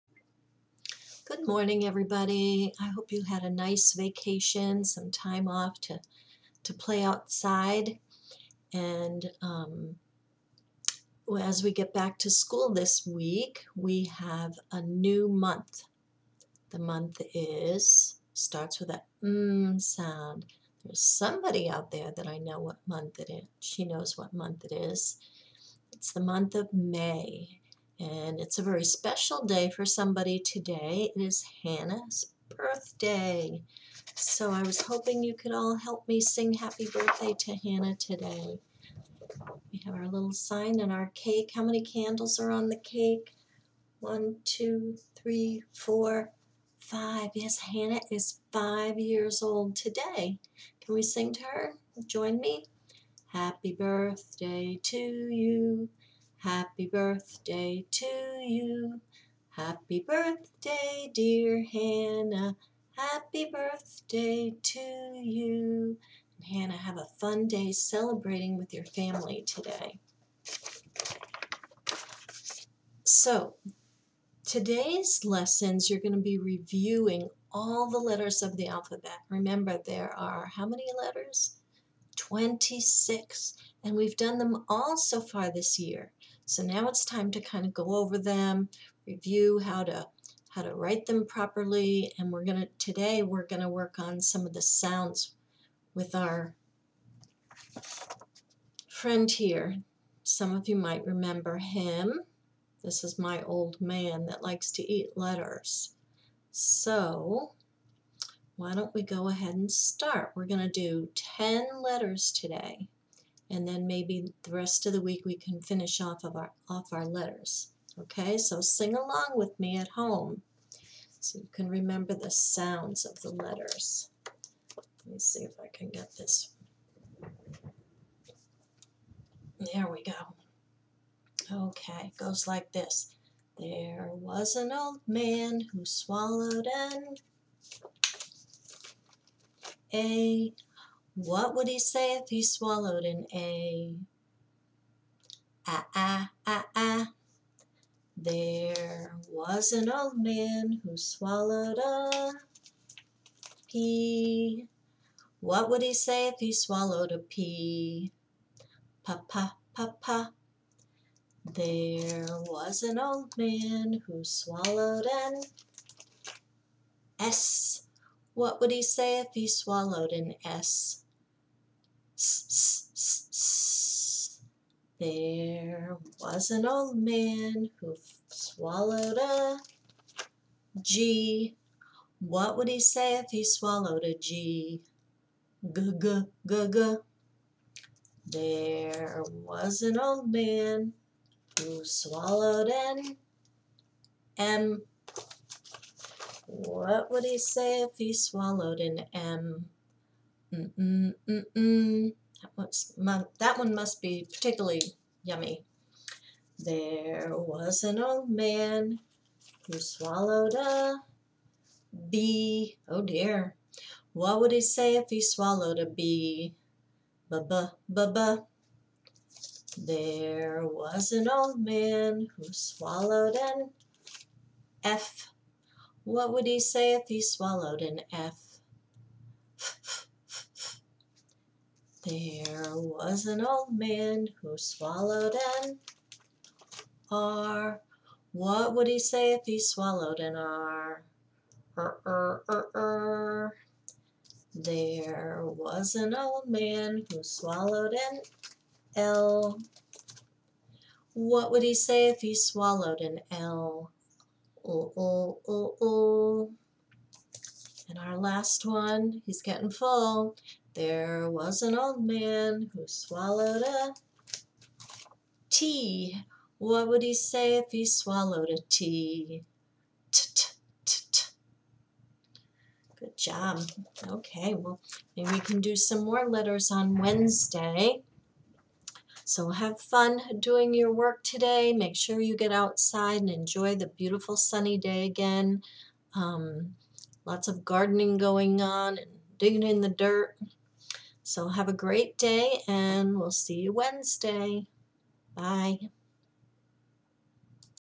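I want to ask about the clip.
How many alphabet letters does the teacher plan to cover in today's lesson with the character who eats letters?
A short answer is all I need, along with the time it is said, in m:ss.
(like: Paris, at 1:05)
10, at 1:51.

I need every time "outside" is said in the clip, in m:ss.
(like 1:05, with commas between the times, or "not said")
0:07, 4:42.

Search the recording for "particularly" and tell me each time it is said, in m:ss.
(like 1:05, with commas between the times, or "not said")
3:24.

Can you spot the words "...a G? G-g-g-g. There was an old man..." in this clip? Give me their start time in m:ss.
3:04.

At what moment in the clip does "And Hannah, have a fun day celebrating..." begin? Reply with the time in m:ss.
1:06.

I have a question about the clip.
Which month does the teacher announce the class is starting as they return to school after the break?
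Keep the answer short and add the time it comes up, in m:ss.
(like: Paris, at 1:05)
May, at 0:26.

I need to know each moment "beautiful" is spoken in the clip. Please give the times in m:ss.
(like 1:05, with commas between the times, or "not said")
4:43.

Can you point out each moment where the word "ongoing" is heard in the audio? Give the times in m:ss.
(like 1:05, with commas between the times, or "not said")
not said.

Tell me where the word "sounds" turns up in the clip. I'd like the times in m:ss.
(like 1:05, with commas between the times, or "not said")
0:19, 1:34, 2:02.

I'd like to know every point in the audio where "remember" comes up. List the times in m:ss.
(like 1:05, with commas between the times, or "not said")
1:19, 1:41, 2:01.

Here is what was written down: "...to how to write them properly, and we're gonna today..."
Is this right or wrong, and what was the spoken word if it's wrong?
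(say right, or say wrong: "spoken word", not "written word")
right.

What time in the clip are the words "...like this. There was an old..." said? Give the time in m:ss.
2:12.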